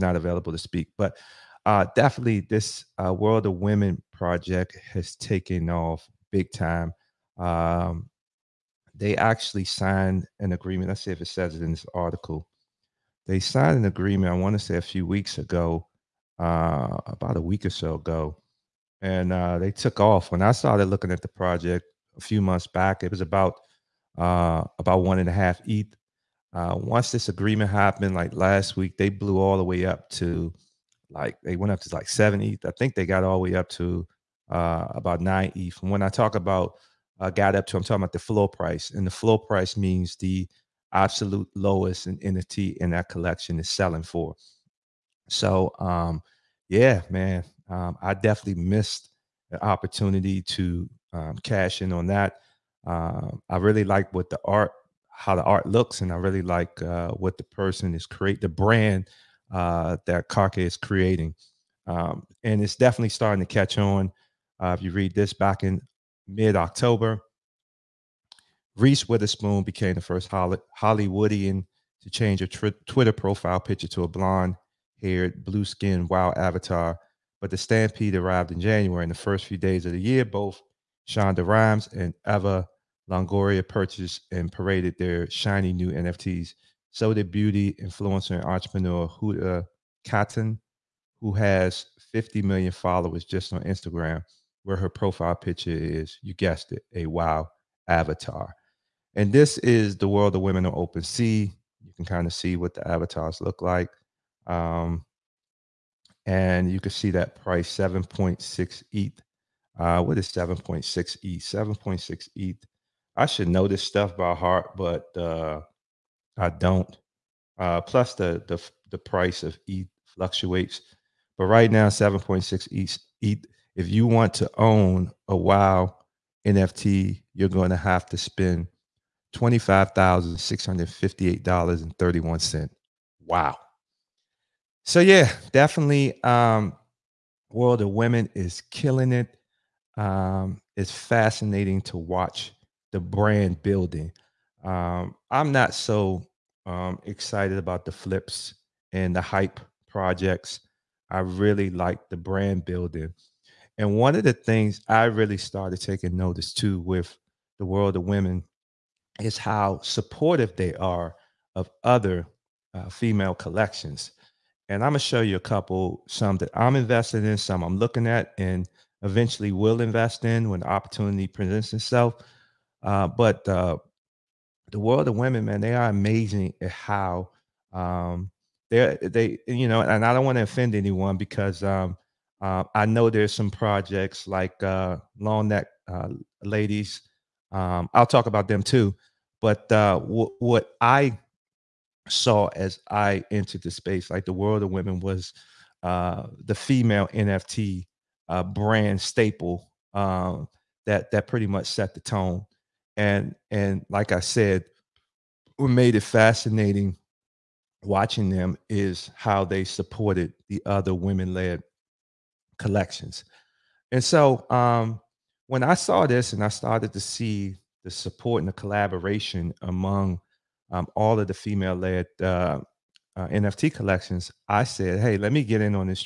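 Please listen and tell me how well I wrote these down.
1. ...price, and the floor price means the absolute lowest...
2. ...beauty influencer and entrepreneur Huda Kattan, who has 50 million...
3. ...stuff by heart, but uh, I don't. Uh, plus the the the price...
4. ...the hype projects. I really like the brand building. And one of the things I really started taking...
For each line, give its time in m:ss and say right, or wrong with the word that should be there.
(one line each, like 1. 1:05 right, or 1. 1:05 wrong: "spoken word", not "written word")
1. 0:38 right
2. 1:27 right
3. 1:53 right
4. 2:29 right.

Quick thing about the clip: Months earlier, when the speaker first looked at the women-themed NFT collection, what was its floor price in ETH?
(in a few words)
1.5 ETH.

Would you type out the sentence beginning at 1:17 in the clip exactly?
But the Stampede arrived in January.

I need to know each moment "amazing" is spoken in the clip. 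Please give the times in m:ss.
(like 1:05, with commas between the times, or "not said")
2:55.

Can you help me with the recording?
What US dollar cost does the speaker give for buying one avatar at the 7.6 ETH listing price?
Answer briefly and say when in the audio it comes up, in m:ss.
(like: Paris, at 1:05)
$25,658.31, at 2:09.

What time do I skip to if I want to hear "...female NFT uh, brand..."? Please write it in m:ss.
3:16.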